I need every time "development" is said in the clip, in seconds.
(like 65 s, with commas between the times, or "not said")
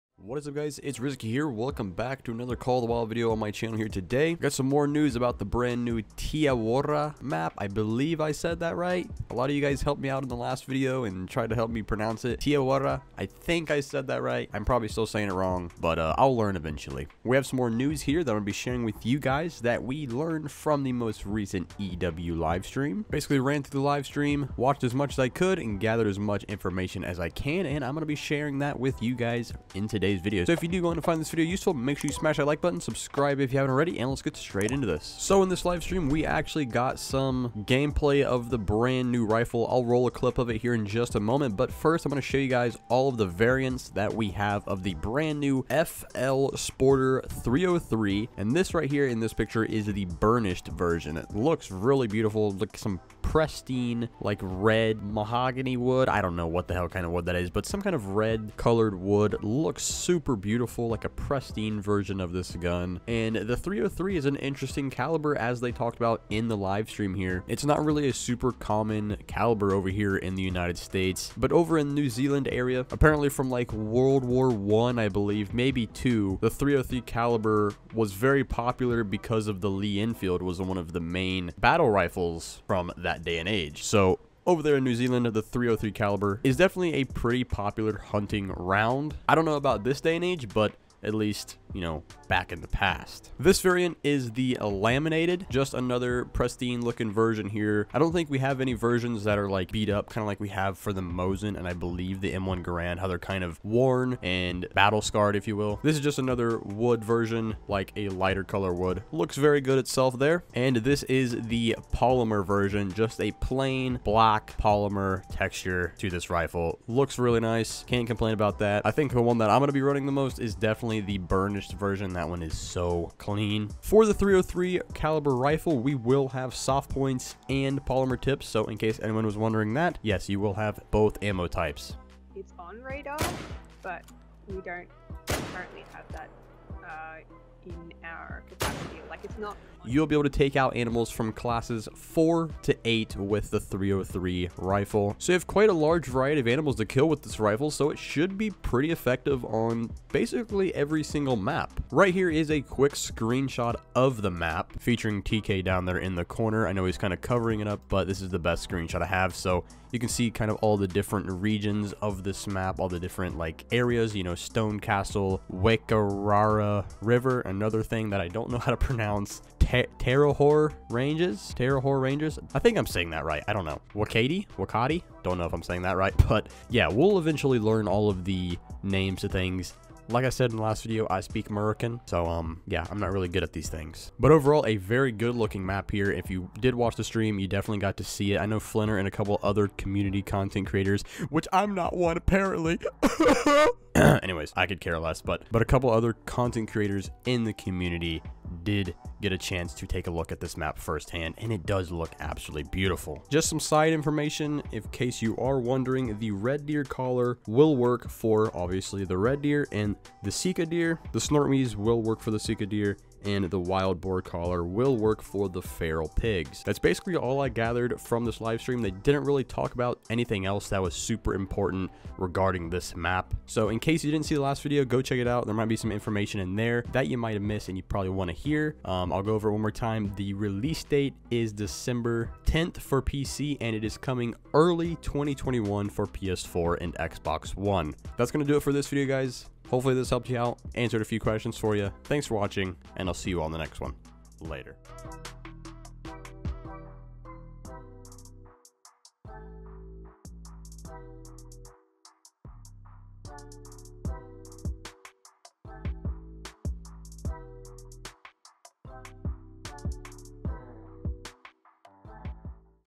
not said.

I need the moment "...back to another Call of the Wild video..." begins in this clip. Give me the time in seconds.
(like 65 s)
1 s.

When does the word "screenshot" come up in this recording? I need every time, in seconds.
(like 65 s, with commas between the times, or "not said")
152 s, 158 s.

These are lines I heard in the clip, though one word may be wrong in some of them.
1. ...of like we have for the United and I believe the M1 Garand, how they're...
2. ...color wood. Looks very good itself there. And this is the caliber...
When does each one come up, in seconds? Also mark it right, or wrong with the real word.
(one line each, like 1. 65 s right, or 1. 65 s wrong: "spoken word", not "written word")
1. 100 s wrong: "Mosin", not "United"
2. 108 s wrong: "polymer", not "caliber".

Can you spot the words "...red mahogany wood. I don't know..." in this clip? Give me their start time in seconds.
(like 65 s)
54 s.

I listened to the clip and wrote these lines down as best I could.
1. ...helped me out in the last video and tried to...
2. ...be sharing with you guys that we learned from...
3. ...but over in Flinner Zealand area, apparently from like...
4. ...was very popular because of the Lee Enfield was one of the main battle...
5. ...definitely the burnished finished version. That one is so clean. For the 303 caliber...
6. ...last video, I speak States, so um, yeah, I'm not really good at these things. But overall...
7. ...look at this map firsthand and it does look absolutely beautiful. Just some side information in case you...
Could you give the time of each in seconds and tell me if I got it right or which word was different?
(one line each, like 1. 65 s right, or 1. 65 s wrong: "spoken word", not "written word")
1. 9 s right
2. 18 s right
3. 71 s wrong: "New", not "Flinner"
4. 77 s right
5. 120 s right
6. 180 s wrong: "American", not "States"
7. 200 s right.